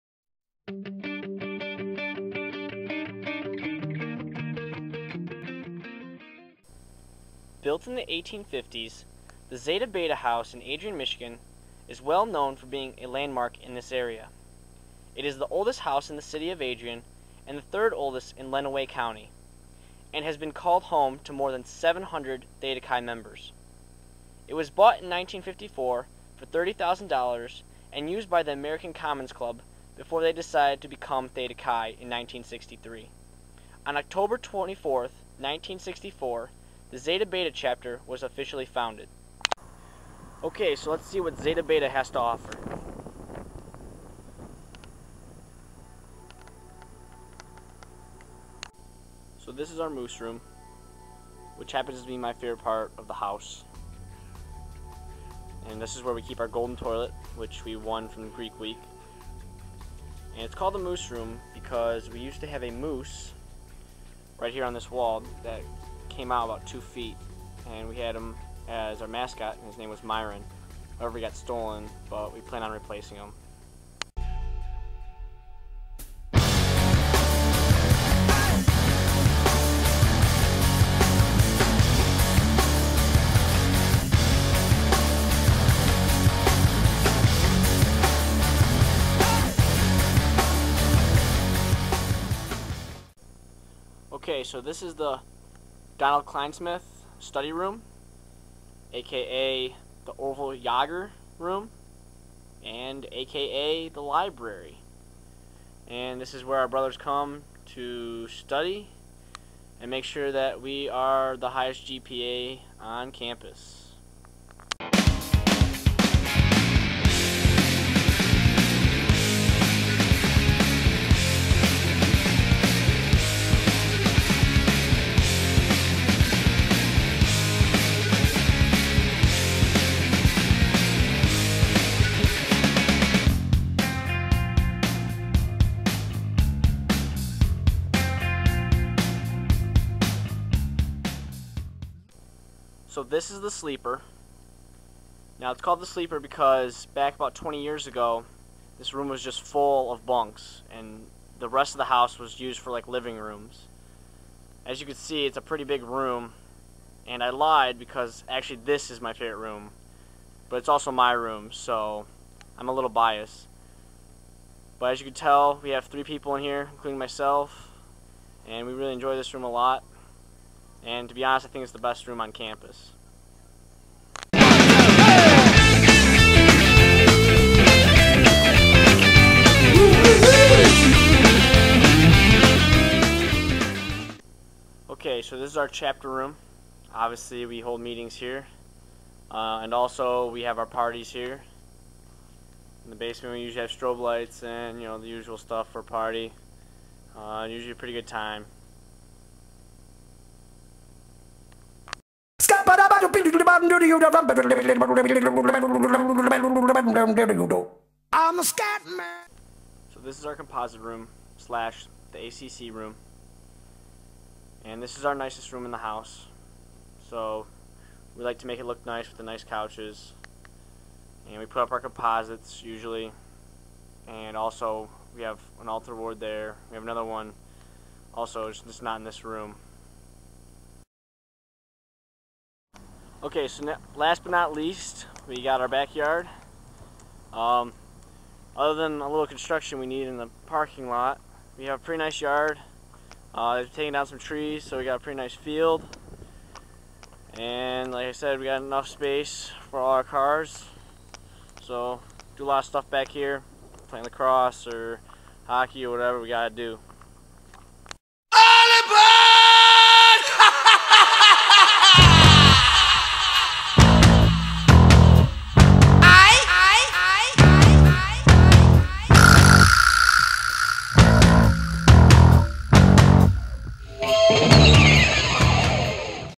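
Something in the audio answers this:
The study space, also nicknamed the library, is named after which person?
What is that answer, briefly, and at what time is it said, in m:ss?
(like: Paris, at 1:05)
Donald Kleinsmith, at 1:36.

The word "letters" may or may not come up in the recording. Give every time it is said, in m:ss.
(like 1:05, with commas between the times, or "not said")
not said.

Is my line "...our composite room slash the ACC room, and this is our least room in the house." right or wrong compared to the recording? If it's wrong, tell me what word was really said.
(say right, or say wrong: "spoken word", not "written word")
wrong: "nicest", not "least".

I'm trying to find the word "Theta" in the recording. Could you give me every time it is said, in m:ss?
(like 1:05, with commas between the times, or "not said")
0:22, 0:31.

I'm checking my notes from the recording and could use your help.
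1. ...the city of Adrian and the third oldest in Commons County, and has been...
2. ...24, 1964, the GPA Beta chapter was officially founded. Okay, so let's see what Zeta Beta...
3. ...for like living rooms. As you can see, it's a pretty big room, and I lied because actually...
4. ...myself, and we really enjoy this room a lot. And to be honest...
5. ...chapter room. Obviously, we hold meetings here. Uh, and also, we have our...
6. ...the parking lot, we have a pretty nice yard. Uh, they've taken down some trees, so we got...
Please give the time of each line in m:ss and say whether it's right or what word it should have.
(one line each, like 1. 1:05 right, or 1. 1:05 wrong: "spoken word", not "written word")
1. 0:16 wrong: "Lenawee", not "Commons"
2. 0:34 wrong: "Zeta", not "GPA"
3. 2:32 right
4. 2:46 right
5. 3:05 right
6. 4:00 right.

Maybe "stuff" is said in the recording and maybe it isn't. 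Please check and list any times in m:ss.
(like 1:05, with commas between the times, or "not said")
3:15, 4:12.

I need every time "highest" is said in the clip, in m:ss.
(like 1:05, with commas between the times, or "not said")
1:51.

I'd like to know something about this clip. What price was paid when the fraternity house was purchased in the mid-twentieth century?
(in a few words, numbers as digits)
$30,000.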